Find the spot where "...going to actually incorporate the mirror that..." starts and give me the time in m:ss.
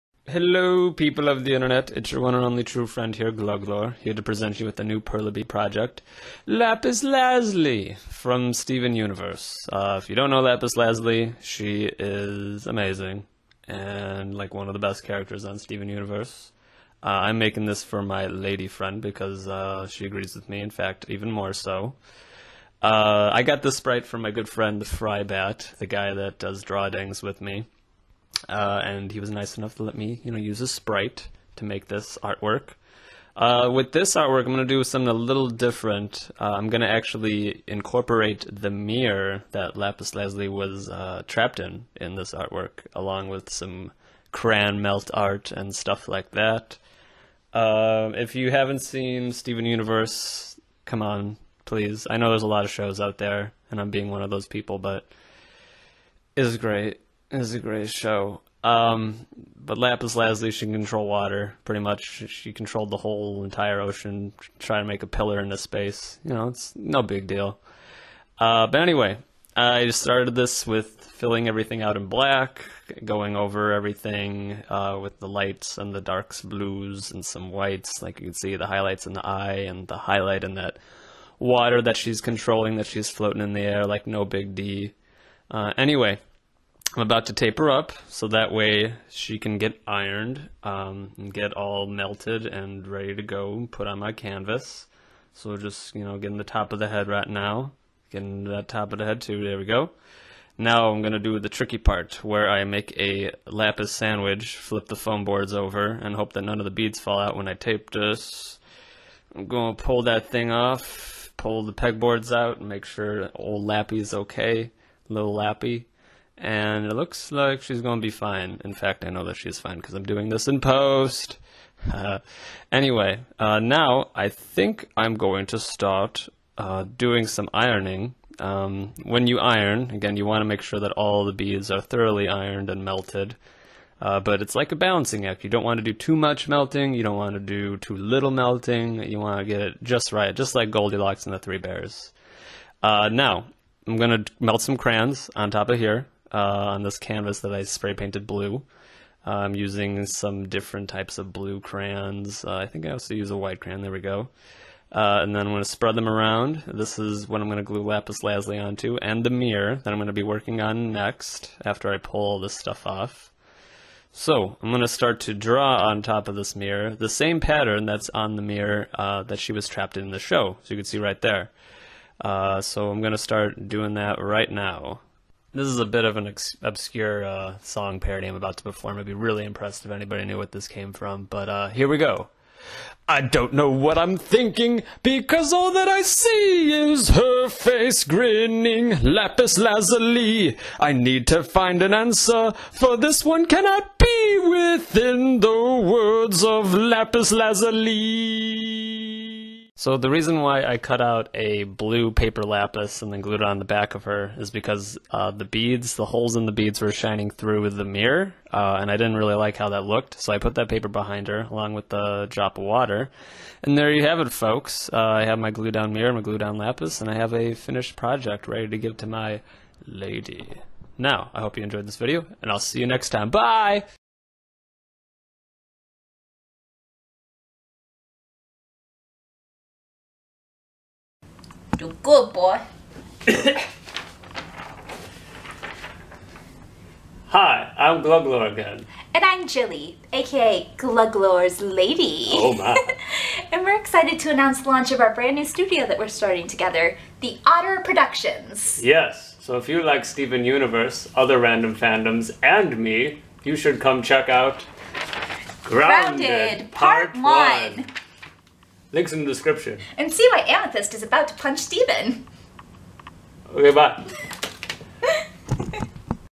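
0:36.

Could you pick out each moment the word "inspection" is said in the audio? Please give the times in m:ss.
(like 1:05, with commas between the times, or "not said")
not said.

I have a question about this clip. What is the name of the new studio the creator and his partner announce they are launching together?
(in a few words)
Otter Productions.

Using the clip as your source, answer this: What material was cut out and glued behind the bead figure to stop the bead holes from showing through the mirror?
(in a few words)
Blue paper.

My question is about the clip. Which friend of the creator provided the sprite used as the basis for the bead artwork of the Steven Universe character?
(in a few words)
Frybat.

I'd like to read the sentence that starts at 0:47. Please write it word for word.
Um, if you haven't seen Steven Universe, come on, please.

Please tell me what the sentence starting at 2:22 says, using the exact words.
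Uh, now, I'm going to melt some crayons on top of here uh, on this canvas that I spray painted blue.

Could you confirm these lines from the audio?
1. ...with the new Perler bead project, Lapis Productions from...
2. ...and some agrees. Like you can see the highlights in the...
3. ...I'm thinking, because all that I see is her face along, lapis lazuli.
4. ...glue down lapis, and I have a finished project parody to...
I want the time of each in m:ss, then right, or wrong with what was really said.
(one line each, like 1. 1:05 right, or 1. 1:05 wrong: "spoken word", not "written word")
1. 0:04 wrong: "Lazuli", not "Productions"
2. 1:17 wrong: "whites", not "agrees"
3. 3:03 wrong: "grinning", not "along"
4. 3:36 wrong: "ready", not "parody".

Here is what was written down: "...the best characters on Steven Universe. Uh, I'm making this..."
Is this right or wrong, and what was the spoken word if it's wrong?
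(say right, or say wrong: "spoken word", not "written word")
right.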